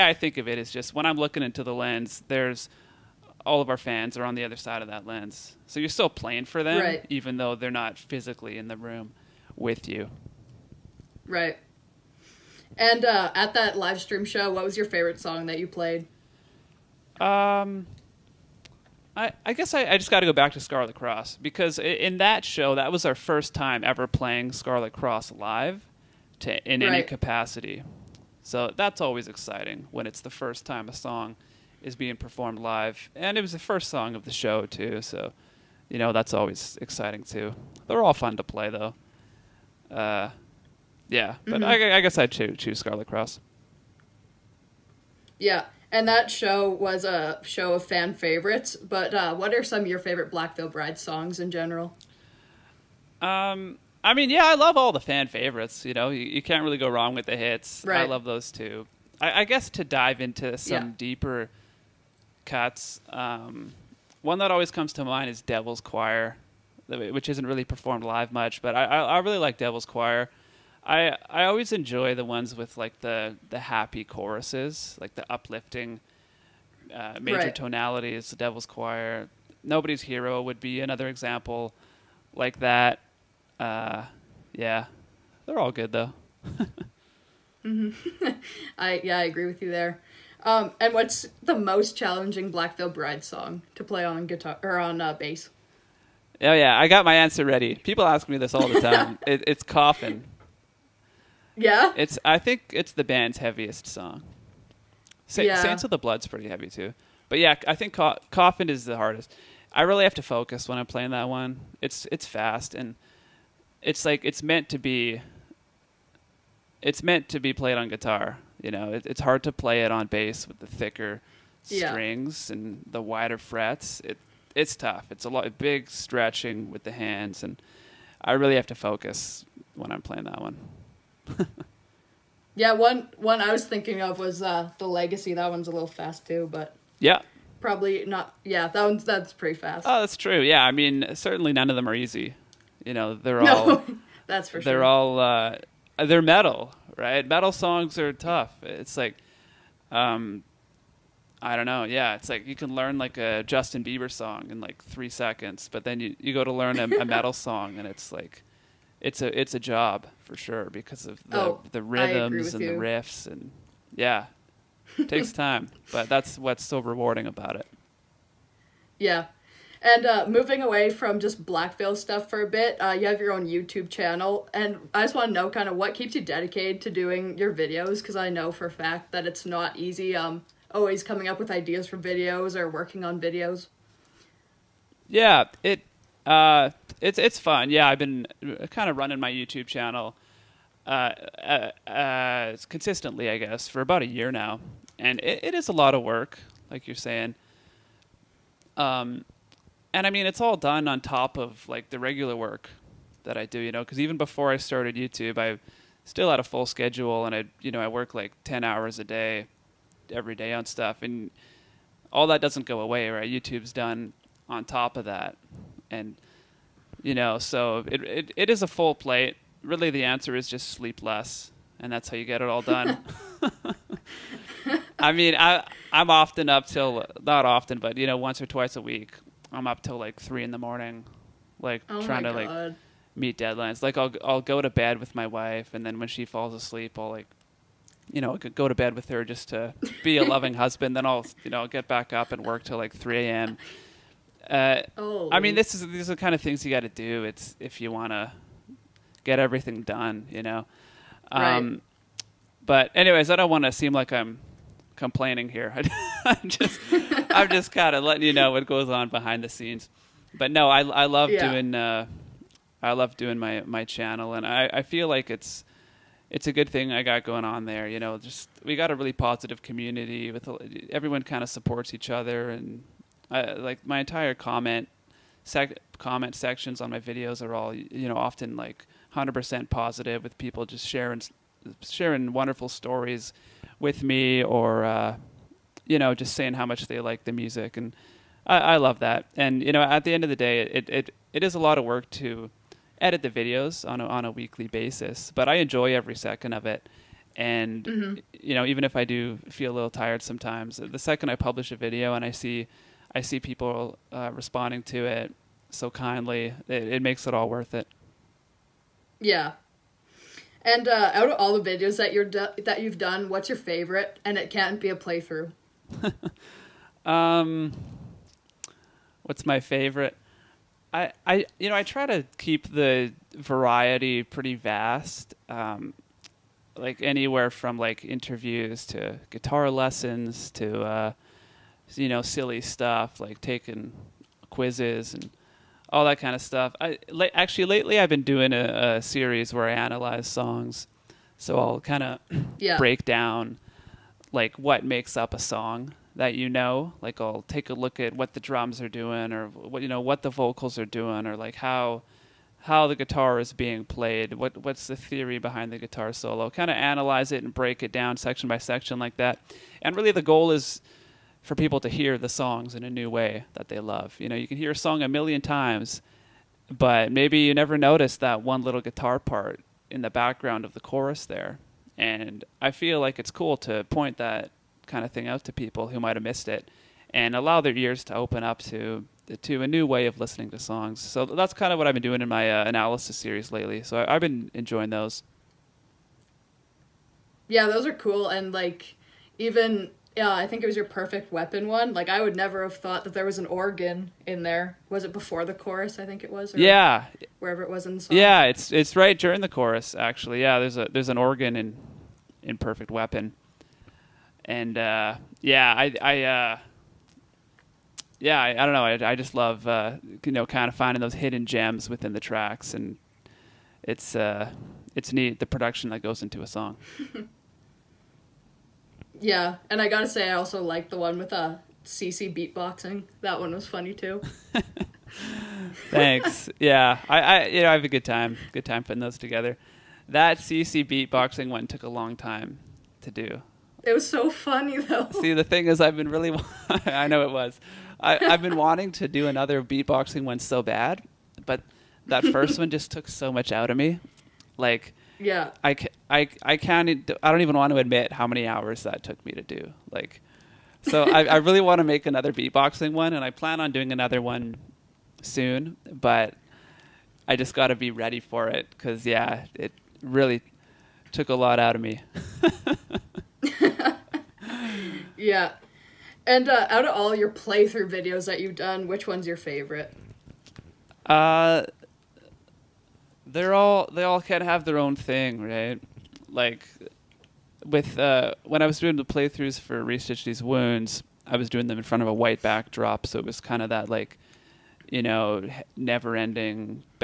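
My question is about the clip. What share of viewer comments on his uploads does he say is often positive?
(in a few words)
100%.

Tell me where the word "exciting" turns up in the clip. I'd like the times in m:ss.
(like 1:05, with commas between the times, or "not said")
0:29, 0:36.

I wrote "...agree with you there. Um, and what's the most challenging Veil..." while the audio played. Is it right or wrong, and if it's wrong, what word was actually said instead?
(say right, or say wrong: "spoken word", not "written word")
right.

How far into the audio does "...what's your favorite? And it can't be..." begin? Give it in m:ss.
5:13.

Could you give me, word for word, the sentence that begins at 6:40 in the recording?
Yeah, there's a there's an organ in in Perfect Weapon.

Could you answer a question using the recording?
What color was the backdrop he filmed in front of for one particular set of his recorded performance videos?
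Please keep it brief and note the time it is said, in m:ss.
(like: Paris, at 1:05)
White, at 8:02.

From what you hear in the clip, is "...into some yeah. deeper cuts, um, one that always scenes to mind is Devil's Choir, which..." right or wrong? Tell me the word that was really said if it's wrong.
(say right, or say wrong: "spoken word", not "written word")
wrong: "comes", not "scenes".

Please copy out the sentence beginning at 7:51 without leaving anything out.
Uh, they're all they all kind of have their own thing, right?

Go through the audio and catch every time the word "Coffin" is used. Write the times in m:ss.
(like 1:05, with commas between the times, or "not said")
1:39, 1:48.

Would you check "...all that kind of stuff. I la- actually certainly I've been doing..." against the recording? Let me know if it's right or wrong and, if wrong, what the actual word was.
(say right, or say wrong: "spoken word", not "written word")
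wrong: "lately", not "certainly".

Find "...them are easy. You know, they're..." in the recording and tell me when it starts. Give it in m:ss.
2:21.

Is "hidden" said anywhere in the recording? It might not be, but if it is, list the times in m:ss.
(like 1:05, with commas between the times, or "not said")
6:51.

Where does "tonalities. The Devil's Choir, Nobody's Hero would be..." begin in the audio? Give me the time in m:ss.
1:17.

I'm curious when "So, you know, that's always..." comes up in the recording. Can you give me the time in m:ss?
0:35.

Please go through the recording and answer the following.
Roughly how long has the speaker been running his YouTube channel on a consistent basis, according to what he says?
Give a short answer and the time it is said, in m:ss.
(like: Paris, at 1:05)
About a year, at 3:13.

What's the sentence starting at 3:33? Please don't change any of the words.
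YouTube's done on top of that, and you know, so it, it, it is a full plate.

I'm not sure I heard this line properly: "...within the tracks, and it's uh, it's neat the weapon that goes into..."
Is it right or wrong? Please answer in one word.
wrong.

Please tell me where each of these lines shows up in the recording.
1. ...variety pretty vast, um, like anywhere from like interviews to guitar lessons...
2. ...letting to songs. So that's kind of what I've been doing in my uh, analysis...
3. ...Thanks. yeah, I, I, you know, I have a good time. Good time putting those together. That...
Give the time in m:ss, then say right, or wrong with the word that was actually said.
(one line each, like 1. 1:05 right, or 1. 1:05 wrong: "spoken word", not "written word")
1. 5:23 right
2. 6:20 wrong: "listening", not "letting"
3. 7:05 right.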